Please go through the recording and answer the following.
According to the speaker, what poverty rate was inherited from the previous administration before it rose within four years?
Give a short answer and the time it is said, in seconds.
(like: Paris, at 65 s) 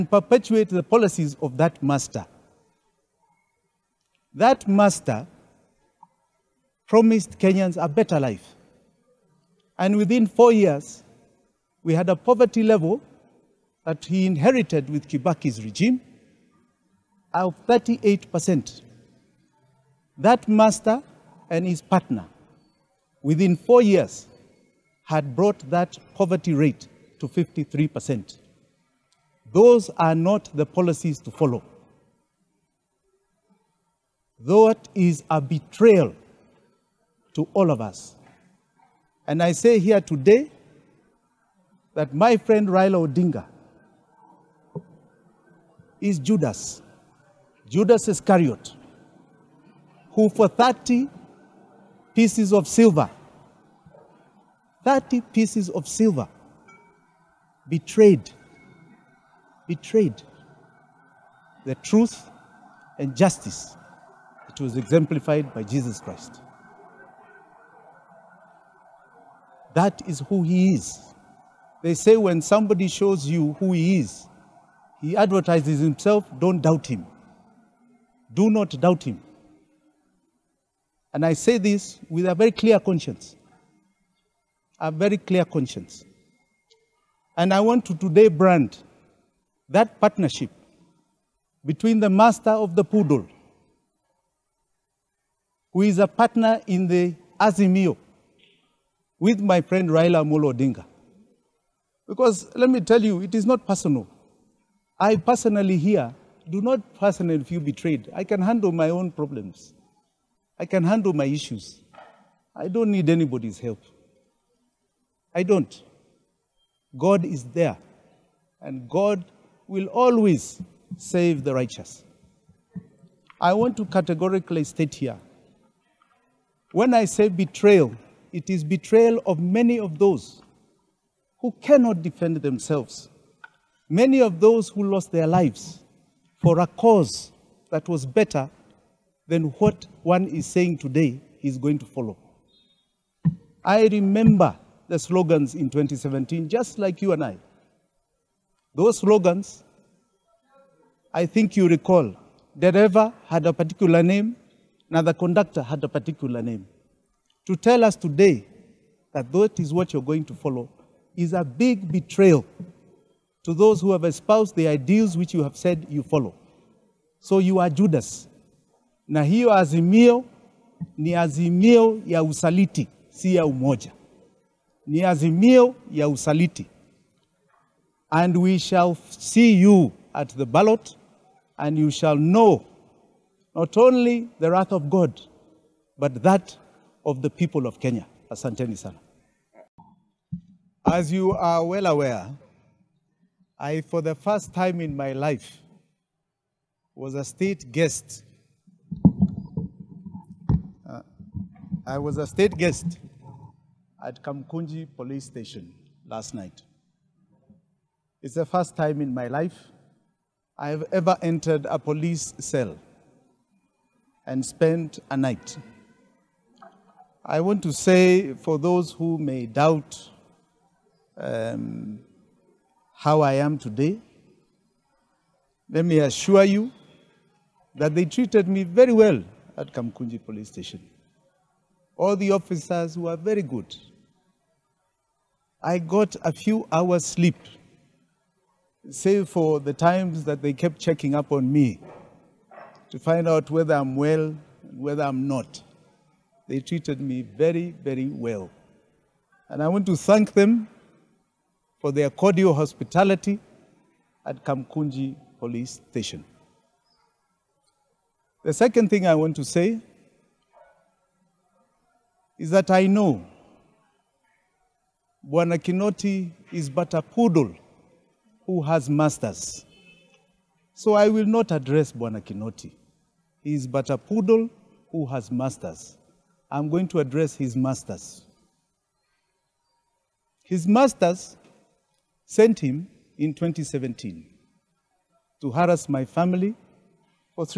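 38%, at 17 s.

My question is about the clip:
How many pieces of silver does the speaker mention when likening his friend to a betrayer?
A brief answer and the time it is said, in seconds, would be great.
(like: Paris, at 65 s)
30, at 50 s.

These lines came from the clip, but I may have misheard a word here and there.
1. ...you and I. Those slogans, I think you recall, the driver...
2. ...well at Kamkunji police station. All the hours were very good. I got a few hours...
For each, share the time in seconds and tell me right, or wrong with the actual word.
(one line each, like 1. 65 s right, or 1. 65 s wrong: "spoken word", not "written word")
1. 147 s right
2. 228 s wrong: "officers", not "hours".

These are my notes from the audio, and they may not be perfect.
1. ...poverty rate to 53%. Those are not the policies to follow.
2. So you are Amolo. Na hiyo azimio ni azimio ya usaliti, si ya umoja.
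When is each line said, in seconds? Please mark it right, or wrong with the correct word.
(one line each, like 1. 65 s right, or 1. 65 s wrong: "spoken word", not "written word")
1. 26 s right
2. 167 s wrong: "Judas", not "Amolo".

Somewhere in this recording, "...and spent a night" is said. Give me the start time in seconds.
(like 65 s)
214 s.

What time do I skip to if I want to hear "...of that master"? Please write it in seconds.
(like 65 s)
1 s.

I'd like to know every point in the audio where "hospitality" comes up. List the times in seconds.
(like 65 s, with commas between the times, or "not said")
252 s.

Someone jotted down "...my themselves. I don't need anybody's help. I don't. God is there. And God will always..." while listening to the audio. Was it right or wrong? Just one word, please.
wrong.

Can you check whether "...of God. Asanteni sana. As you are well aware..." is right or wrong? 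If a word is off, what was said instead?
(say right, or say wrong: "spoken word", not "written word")
wrong: "Kenya", not "God".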